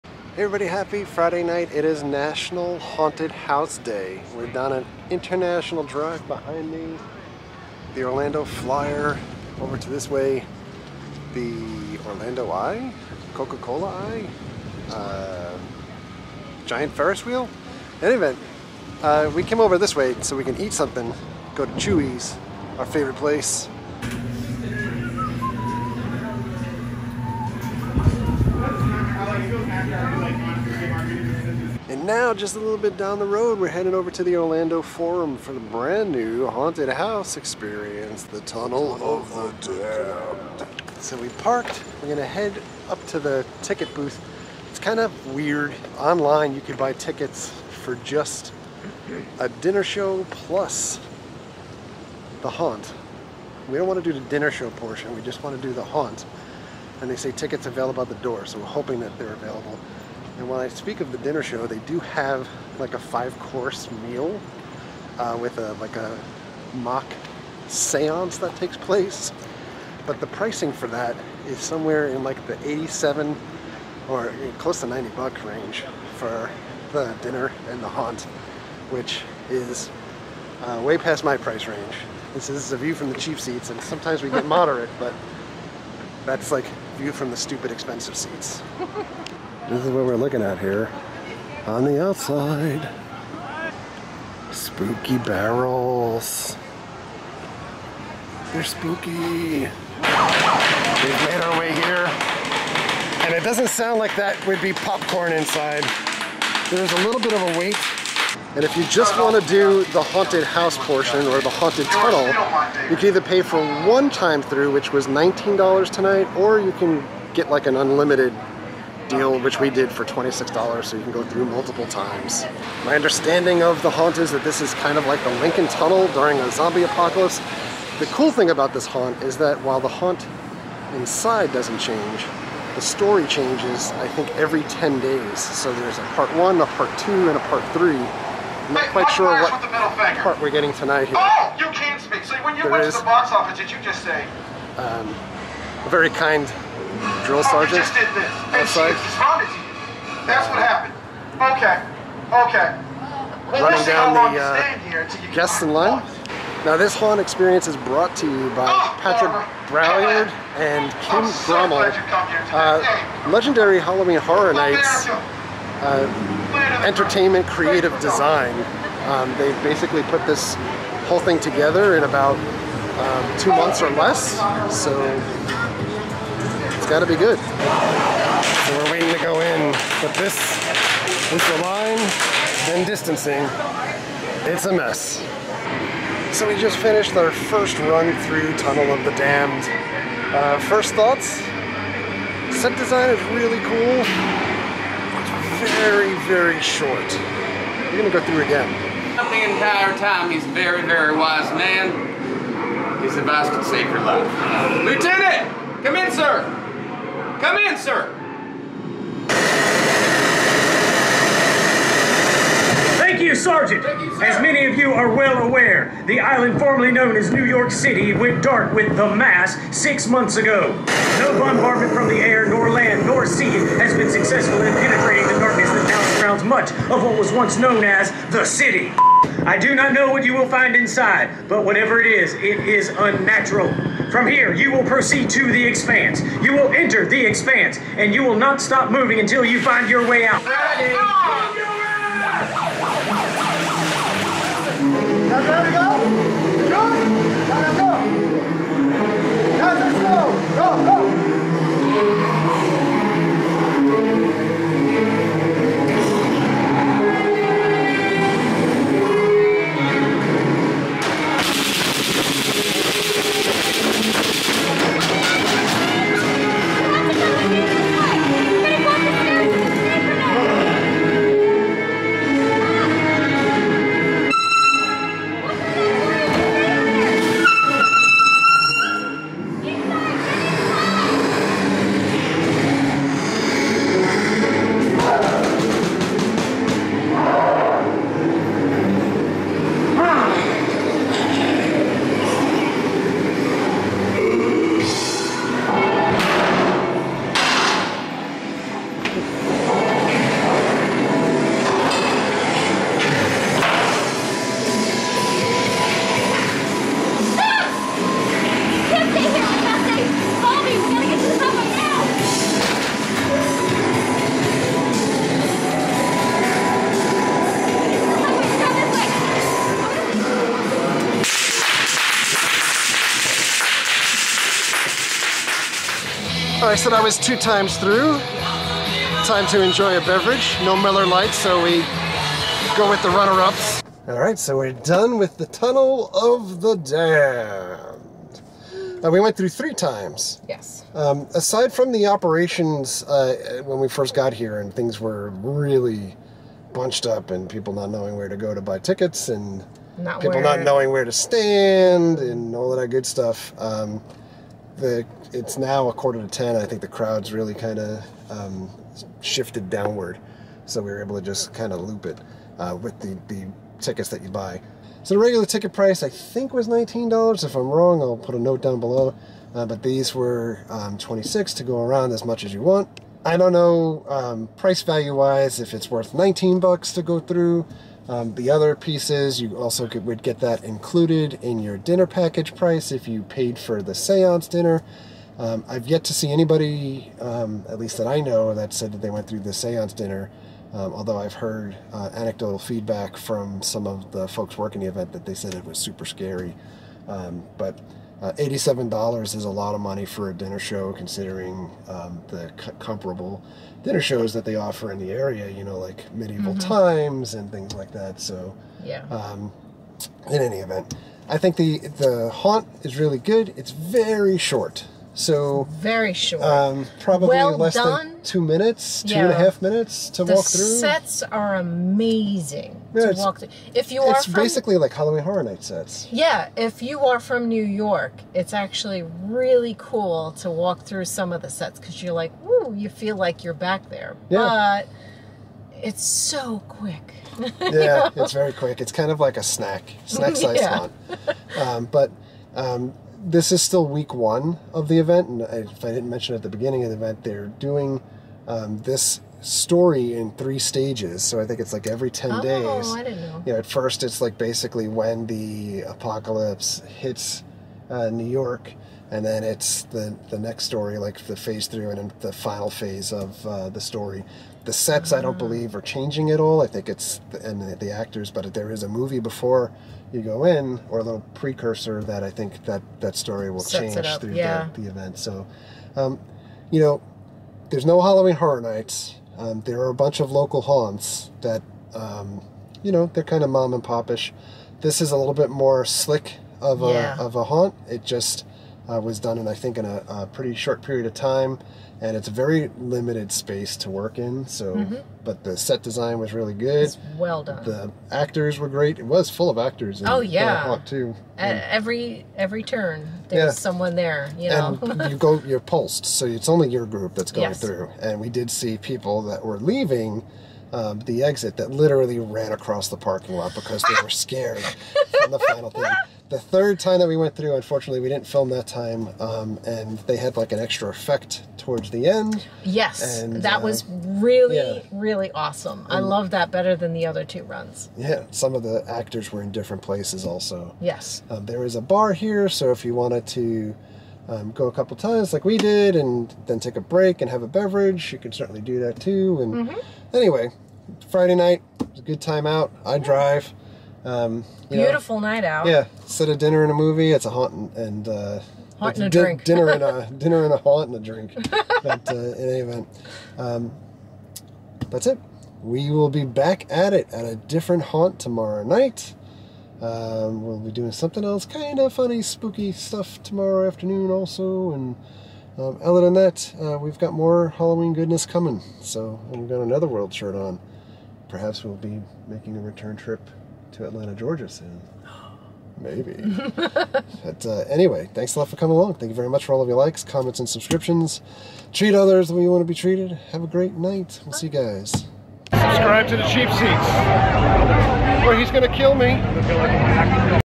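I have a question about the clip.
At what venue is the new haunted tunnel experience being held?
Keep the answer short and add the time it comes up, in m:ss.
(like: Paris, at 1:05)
Orlando Forum, at 0:34.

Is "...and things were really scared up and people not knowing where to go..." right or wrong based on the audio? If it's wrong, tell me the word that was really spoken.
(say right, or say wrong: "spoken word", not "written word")
wrong: "bunched", not "scared".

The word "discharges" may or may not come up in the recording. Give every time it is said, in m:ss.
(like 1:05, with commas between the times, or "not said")
not said.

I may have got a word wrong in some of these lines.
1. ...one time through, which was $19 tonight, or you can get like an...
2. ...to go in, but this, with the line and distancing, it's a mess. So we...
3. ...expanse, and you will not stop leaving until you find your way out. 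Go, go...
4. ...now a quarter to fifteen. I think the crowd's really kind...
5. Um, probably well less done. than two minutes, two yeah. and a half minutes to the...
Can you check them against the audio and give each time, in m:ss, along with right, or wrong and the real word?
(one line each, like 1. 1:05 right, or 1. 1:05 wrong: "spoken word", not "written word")
1. 1:53 right
2. 2:59 right
3. 3:57 wrong: "moving", not "leaving"
4. 5:55 wrong: "ten", not "fifteen"
5. 6:56 right.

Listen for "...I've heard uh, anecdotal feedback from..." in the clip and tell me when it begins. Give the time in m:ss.
6:31.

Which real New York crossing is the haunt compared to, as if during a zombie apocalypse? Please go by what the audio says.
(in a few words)
Lincoln Tunnel.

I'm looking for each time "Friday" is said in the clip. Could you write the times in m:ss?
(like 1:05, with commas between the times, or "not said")
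0:01, 9:01.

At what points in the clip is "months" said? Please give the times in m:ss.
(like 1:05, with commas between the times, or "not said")
2:53, 3:40.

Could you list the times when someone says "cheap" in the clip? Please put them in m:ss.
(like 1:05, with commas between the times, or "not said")
1:23, 9:46.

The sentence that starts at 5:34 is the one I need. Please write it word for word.
All right, so we're done with the Tunnel of the Damned.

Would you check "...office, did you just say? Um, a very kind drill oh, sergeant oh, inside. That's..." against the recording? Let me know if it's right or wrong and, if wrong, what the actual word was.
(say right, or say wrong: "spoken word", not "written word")
wrong: "outside", not "inside".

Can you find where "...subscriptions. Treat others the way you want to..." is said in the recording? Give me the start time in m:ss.
9:40.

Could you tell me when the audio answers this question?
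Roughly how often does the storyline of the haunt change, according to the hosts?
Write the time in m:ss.
2:14.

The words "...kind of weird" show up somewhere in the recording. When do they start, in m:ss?
0:44.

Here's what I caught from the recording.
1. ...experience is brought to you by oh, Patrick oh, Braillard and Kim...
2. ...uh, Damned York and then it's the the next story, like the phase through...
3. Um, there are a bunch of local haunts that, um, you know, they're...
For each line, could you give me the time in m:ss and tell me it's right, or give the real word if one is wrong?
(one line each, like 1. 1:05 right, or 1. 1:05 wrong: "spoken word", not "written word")
1. 2:37 right
2. 7:37 wrong: "New", not "Damned"
3. 7:59 right.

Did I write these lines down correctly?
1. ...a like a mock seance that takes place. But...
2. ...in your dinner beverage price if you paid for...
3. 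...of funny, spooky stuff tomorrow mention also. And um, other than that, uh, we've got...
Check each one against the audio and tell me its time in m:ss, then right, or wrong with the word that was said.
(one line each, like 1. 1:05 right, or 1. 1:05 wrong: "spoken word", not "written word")
1. 1:05 right
2. 6:21 wrong: "package", not "beverage"
3. 9:21 wrong: "afternoon", not "mention".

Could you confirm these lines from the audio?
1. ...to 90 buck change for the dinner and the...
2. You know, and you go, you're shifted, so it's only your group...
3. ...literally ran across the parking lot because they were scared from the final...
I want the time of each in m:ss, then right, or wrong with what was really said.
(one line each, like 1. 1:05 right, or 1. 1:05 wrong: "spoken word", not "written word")
1. 1:14 wrong: "range", not "change"
2. 8:24 wrong: "pulsed", not "shifted"
3. 8:31 right.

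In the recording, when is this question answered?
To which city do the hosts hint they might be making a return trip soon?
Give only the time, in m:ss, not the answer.
9:33.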